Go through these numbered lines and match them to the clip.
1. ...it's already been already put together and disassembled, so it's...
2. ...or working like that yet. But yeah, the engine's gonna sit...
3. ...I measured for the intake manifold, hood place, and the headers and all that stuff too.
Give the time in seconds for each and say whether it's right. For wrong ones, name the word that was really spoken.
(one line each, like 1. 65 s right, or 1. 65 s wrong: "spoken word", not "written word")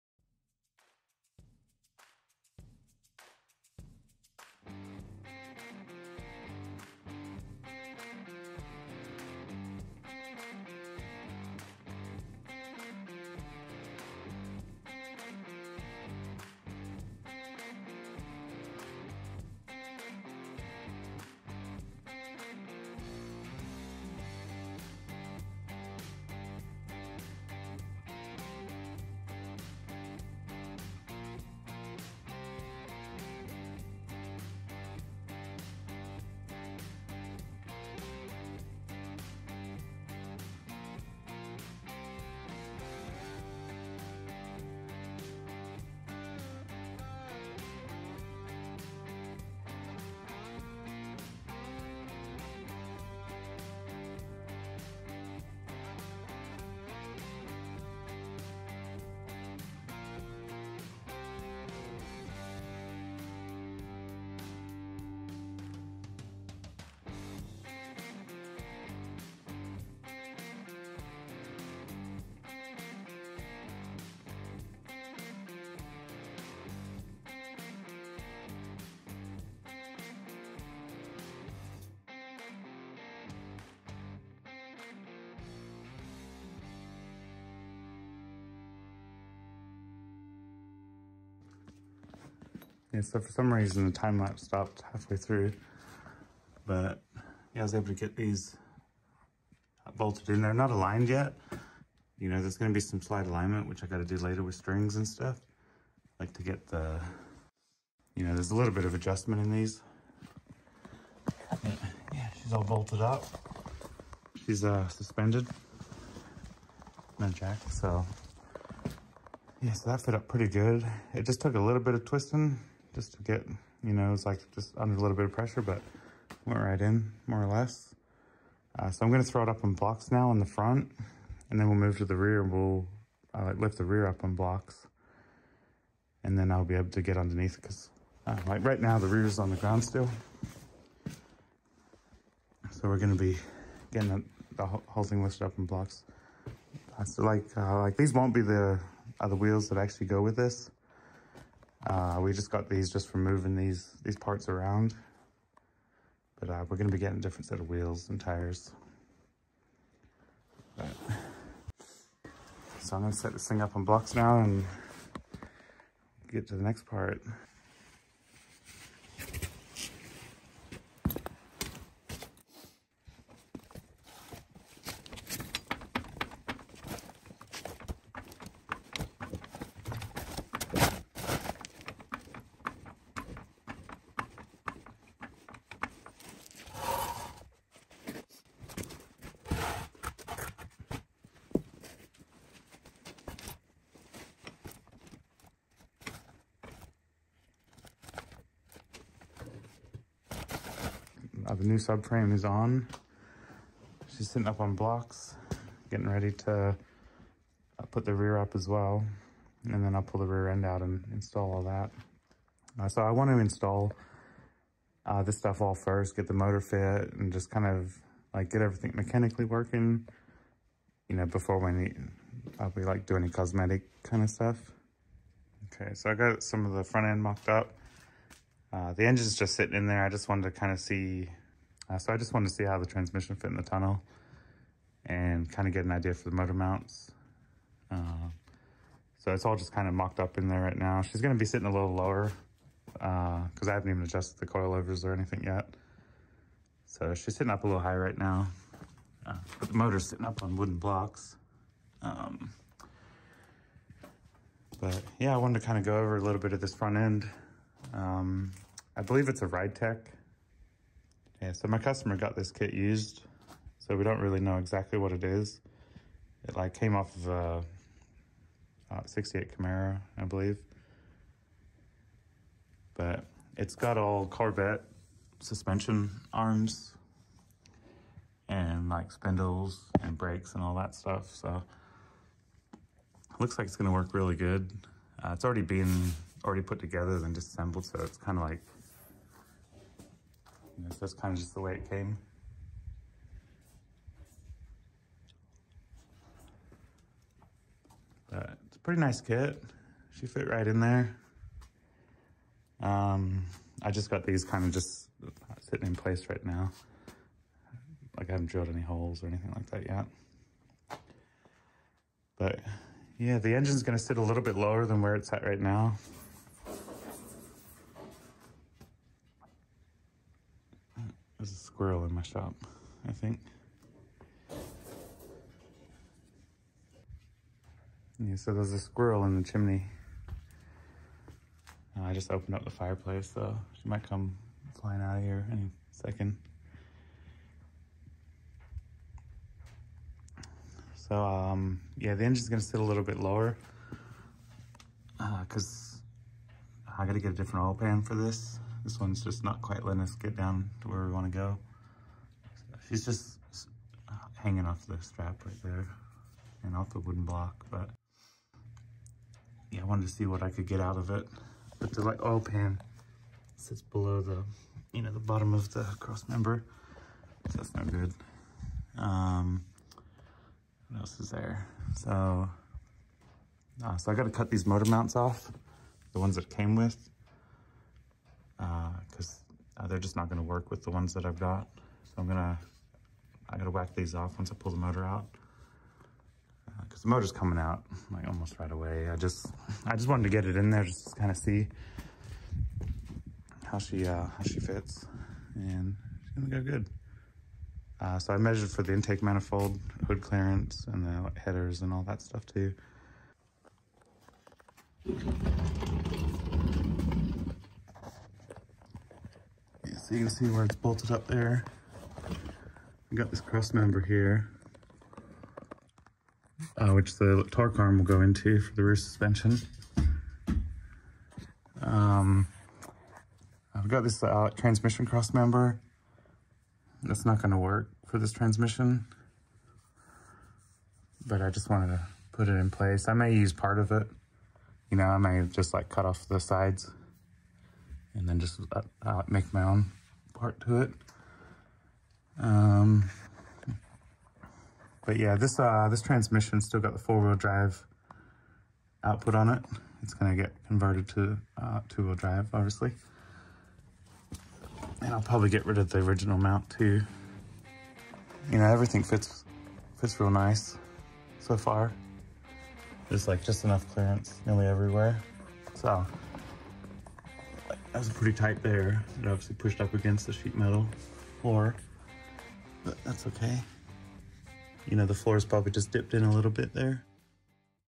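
1. 285 s right
2. 309 s wrong: "anything", not "working"
3. 398 s wrong: "clearance", not "place".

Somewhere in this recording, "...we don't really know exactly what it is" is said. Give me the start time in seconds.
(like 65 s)
263 s.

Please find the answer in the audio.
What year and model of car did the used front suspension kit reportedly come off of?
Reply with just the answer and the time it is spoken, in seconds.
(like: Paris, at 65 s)
68 Camaro, at 269 s.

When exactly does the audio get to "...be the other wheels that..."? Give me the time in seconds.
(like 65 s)
148 s.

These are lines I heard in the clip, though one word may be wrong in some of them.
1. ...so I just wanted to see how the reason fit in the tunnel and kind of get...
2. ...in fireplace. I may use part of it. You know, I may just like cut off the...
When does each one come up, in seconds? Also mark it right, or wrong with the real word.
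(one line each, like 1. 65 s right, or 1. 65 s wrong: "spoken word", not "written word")
1. 231 s wrong: "transmission", not "reason"
2. 432 s wrong: "place", not "fireplace".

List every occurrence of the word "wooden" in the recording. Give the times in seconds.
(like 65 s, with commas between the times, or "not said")
250 s, 356 s.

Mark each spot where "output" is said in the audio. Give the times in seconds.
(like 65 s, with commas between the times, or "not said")
449 s.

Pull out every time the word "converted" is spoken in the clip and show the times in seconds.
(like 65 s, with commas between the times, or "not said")
450 s.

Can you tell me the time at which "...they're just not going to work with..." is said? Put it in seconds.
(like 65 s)
379 s.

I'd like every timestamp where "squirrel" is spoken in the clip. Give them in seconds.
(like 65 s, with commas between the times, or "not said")
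321 s, 328 s.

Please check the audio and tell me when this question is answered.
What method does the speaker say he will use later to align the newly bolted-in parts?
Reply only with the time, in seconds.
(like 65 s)
104 s.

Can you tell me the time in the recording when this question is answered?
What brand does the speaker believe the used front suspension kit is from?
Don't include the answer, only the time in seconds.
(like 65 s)
259 s.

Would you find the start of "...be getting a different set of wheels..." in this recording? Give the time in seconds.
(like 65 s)
156 s.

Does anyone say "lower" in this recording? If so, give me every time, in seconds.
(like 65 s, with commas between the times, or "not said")
241 s, 314 s, 343 s.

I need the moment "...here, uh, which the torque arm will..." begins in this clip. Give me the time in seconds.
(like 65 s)
413 s.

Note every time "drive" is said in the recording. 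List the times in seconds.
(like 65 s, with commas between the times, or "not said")
447 s, 452 s.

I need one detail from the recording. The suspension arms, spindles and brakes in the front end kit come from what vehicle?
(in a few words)
Corvette.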